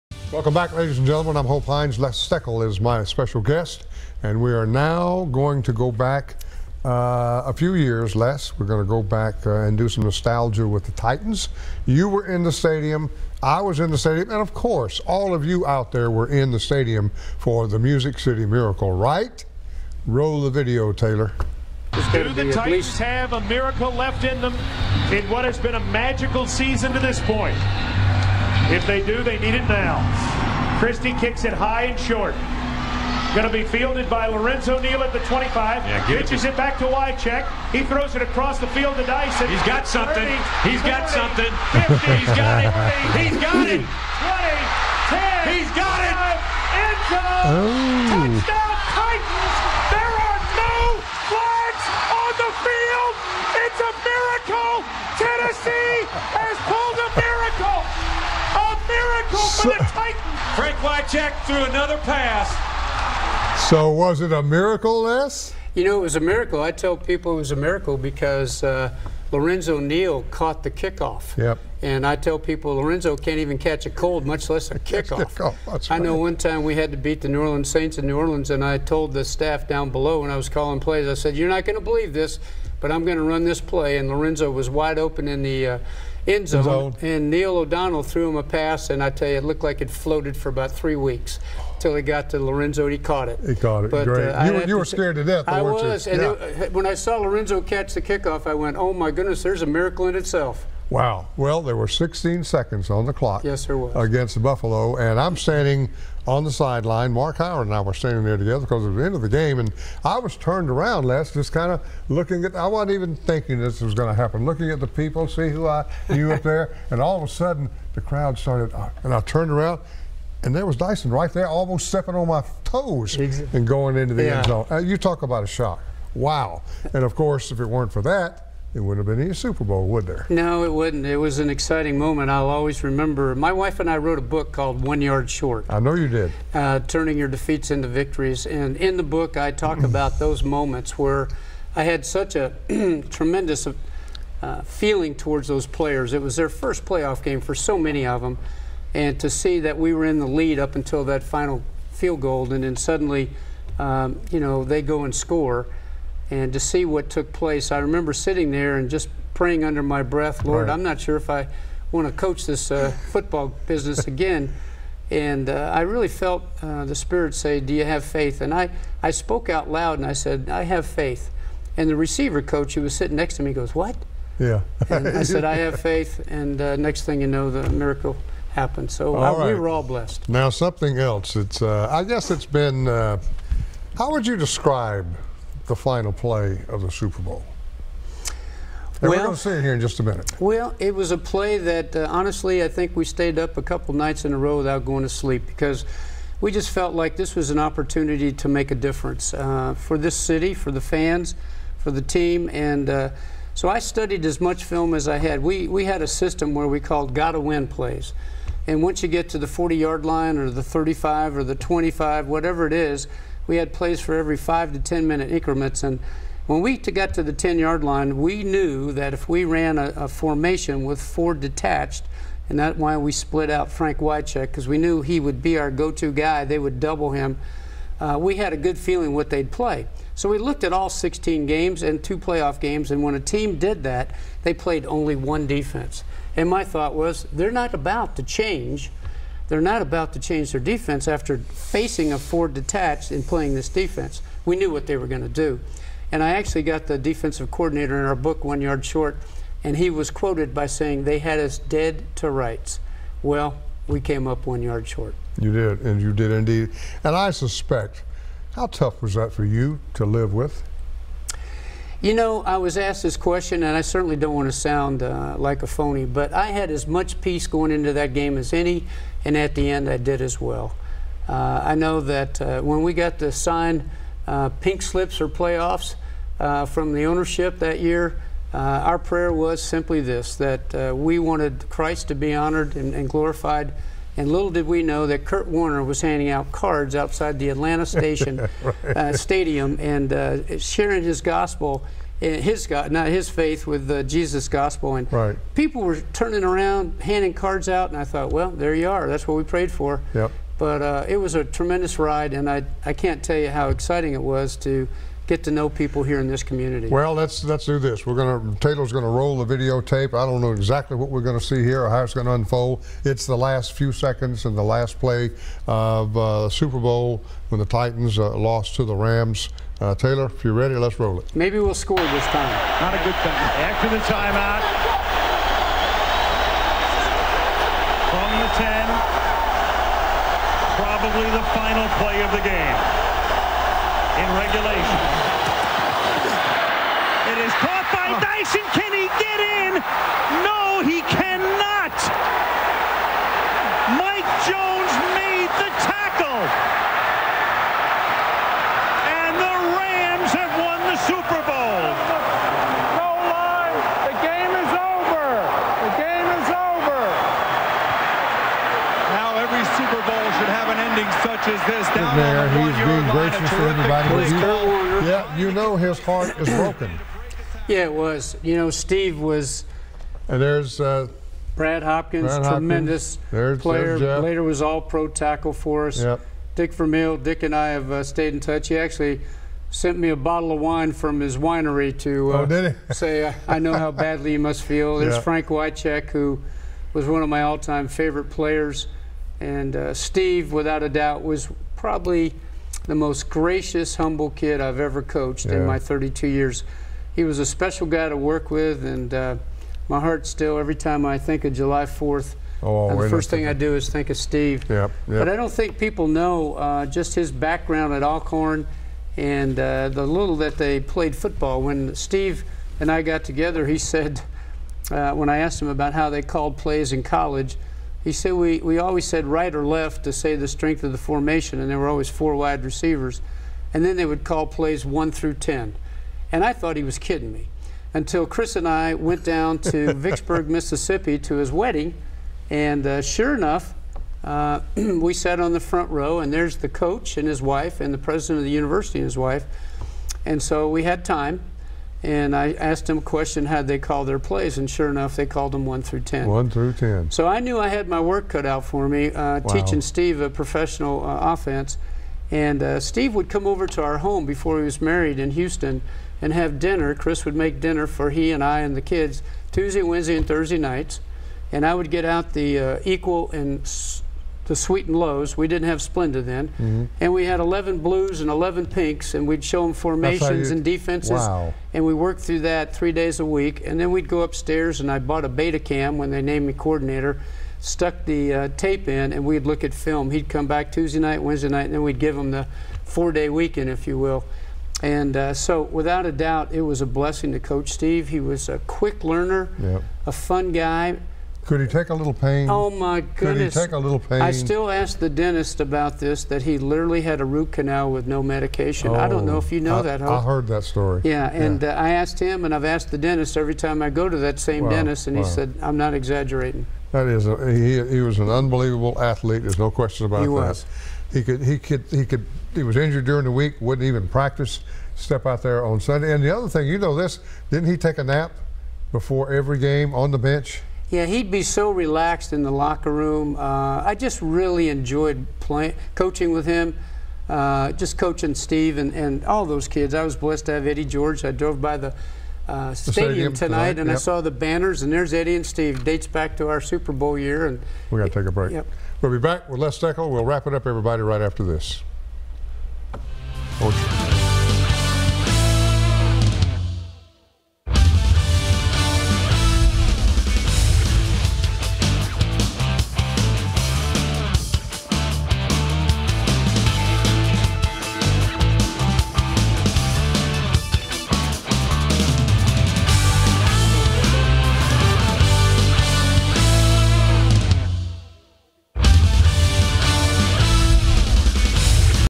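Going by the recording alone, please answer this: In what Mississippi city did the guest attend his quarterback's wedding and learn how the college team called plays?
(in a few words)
Vicksburg.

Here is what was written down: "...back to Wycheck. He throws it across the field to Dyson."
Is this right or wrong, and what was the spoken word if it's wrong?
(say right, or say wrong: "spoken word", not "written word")
right.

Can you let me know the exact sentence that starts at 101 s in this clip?
Well, there were 16 seconds on the clock.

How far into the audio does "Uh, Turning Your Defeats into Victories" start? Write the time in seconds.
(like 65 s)
136 s.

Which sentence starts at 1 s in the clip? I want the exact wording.
Les Steckel is my special guest, and we are now going to go back uh, a few years, Les.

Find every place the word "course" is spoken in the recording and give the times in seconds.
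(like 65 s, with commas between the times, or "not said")
14 s, 127 s.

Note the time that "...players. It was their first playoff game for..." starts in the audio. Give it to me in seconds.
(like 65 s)
145 s.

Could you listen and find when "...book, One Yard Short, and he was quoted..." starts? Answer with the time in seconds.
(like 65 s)
248 s.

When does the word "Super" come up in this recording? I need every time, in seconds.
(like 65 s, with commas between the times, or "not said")
129 s, 186 s, 316 s, 359 s, 536 s.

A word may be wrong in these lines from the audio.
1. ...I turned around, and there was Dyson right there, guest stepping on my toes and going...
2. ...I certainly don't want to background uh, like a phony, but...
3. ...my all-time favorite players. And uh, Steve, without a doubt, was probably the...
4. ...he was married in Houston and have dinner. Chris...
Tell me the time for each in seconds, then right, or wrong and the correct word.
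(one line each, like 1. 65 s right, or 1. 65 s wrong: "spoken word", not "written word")
1. 119 s wrong: "almost", not "guest"
2. 263 s wrong: "sound", not "background"
3. 387 s right
4. 454 s right.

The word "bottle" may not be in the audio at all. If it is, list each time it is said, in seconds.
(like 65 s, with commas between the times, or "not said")
380 s.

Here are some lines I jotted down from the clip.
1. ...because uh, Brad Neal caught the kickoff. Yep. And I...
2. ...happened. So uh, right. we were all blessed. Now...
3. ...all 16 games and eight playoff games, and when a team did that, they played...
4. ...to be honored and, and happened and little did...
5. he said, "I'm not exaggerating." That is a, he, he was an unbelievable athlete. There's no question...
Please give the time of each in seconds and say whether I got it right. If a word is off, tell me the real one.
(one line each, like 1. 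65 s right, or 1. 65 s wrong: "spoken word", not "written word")
1. 67 s wrong: "Lorenzo", not "Brad"
2. 178 s right
3. 230 s wrong: "two", not "eight"
4. 282 s wrong: "glorified", not "happened"
5. 505 s right.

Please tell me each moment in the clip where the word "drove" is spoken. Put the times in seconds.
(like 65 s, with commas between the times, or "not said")
531 s.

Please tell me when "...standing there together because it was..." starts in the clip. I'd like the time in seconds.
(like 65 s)
107 s.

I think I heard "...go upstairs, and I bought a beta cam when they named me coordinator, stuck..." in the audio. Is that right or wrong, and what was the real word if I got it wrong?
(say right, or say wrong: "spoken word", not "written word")
right.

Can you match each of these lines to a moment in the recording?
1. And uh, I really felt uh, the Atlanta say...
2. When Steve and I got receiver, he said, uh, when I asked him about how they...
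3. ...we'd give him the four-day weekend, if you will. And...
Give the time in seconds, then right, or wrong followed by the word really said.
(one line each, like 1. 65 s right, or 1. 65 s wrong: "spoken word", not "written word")
1. 165 s wrong: "Spirit", not "Atlanta"
2. 411 s wrong: "together", not "receiver"
3. 481 s right.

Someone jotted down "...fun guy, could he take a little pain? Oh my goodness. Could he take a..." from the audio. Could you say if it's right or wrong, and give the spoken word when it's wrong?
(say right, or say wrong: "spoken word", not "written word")
right.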